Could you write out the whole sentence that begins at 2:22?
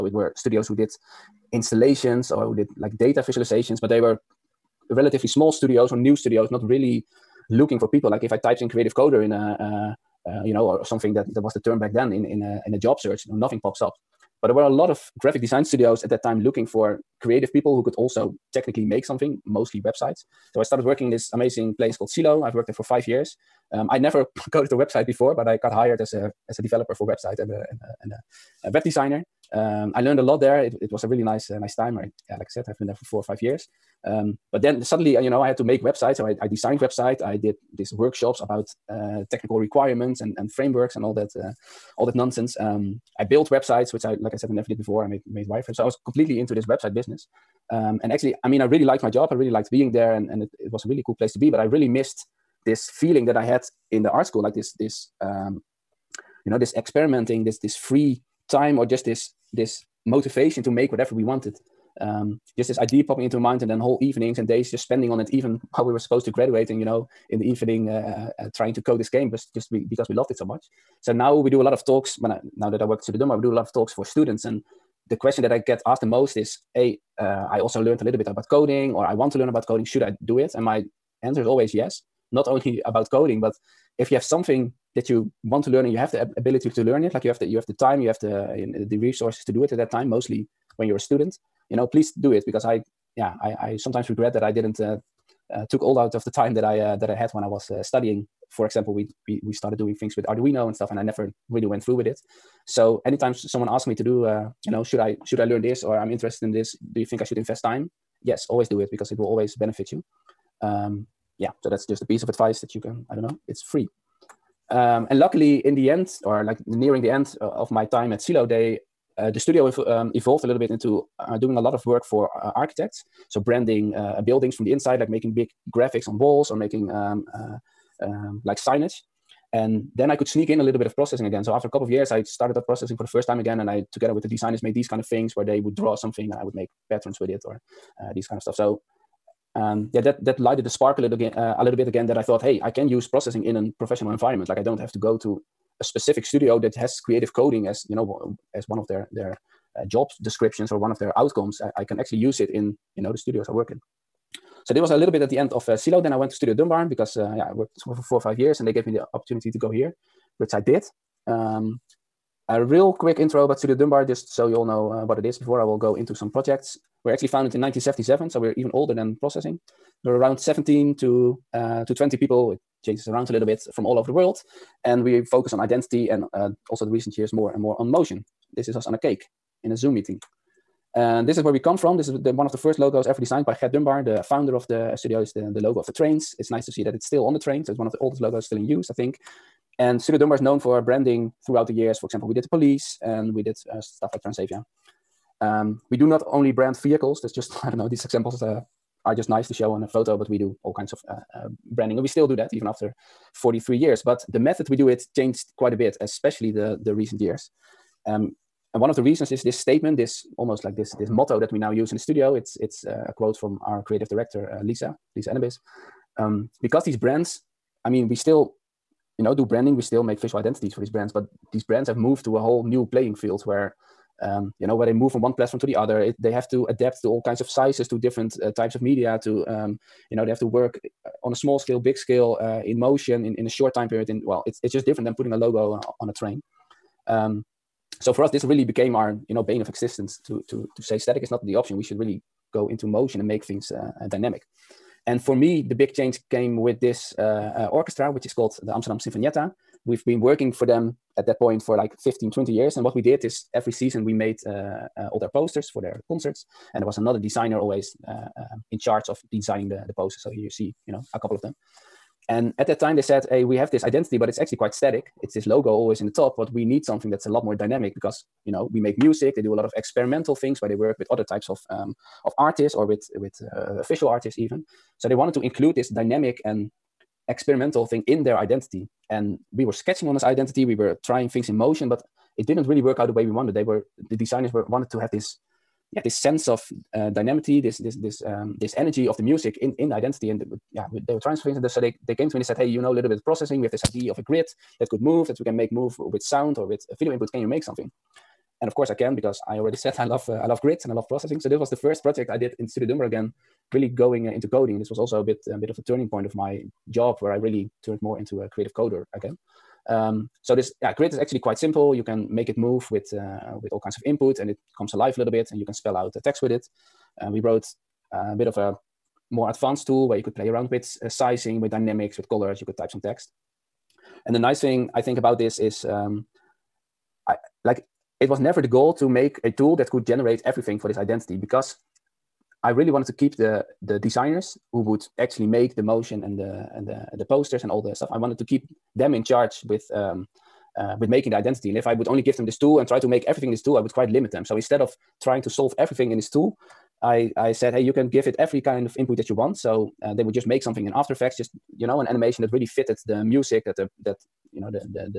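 That I thought, hey, I can use processing in a professional environment.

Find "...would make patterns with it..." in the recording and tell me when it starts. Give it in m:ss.
2:16.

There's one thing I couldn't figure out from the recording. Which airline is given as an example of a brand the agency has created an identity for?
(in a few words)
Transavia.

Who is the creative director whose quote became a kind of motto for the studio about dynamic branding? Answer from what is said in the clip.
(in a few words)
Liza Enebeis.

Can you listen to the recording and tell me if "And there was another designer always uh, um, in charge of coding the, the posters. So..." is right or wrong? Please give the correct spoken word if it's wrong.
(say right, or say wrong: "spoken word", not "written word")
wrong: "designing", not "coding".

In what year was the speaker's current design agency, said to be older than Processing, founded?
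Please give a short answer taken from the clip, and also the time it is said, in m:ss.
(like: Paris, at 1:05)
1977, at 2:47.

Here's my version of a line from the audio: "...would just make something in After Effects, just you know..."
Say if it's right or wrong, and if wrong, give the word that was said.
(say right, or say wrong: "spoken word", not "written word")
right.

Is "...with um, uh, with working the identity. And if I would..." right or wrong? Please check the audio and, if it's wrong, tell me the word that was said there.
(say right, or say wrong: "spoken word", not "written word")
wrong: "making", not "working".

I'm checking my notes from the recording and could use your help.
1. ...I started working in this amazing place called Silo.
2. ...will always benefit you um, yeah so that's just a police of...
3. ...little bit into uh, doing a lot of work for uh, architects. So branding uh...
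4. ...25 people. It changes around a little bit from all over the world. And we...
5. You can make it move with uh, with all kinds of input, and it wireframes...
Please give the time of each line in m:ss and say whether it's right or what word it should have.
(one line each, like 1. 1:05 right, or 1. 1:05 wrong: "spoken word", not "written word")
1. 0:20 right
2. 1:49 wrong: "piece", not "police"
3. 2:00 right
4. 2:51 wrong: "20", not "25"
5. 5:11 wrong: "comes", not "wireframes".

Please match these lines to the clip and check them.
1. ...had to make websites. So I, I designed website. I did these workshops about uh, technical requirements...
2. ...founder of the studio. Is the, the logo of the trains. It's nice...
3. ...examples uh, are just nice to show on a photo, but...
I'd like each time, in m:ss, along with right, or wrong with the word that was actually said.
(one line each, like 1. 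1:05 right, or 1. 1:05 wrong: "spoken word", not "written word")
1. 0:35 right
2. 3:04 right
3. 3:18 right.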